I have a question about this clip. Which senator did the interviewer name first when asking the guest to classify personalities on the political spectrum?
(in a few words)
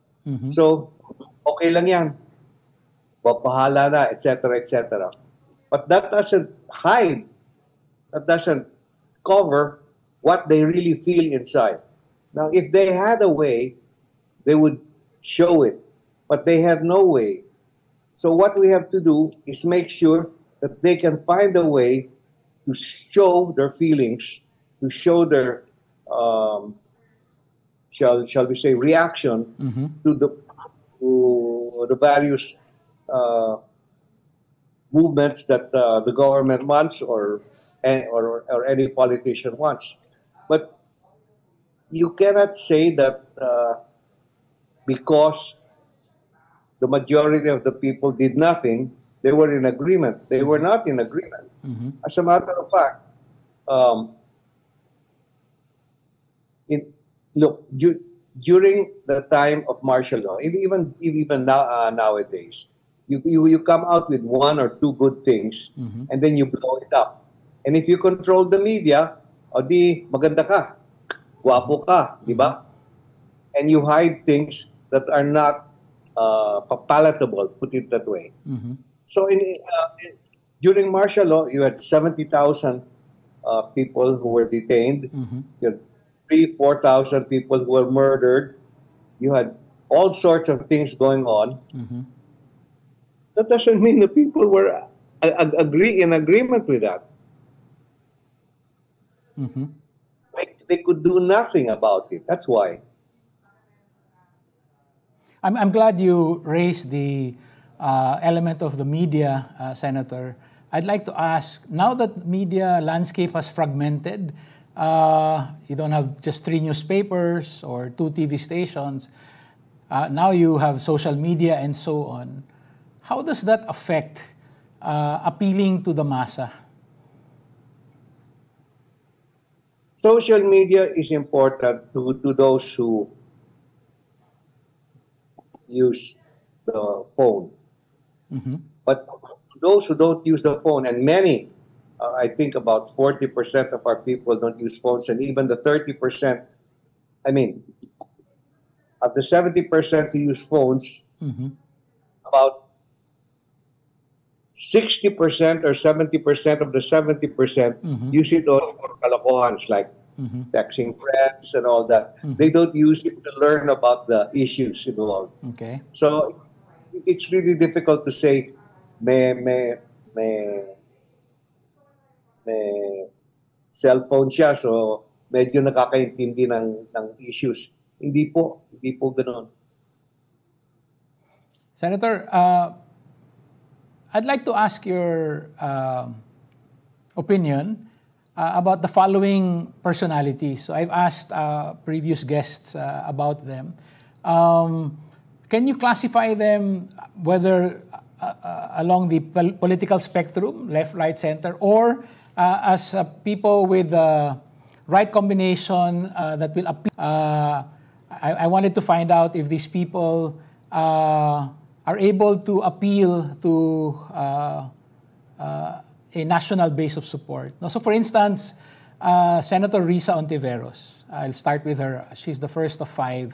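Risa Hontiveros.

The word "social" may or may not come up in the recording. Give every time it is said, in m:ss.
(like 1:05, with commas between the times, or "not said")
2:00, 2:09.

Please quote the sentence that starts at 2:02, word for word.
How does that affect uh, appealing to the massa?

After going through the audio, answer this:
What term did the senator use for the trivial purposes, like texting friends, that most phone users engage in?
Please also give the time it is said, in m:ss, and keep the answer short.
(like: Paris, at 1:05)
kalokohans, at 2:38.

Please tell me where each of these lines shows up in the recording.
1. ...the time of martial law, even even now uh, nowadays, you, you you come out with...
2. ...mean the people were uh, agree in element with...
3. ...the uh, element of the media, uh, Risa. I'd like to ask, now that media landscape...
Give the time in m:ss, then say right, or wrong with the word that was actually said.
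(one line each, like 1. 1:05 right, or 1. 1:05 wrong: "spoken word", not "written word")
1. 0:59 right
2. 1:33 wrong: "agreement", not "element"
3. 1:46 wrong: "Senator", not "Risa".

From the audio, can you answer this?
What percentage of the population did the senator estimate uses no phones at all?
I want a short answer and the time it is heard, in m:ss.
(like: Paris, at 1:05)
40%, at 2:22.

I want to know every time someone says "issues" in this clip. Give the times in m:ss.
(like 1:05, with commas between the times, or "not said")
2:44, 2:57.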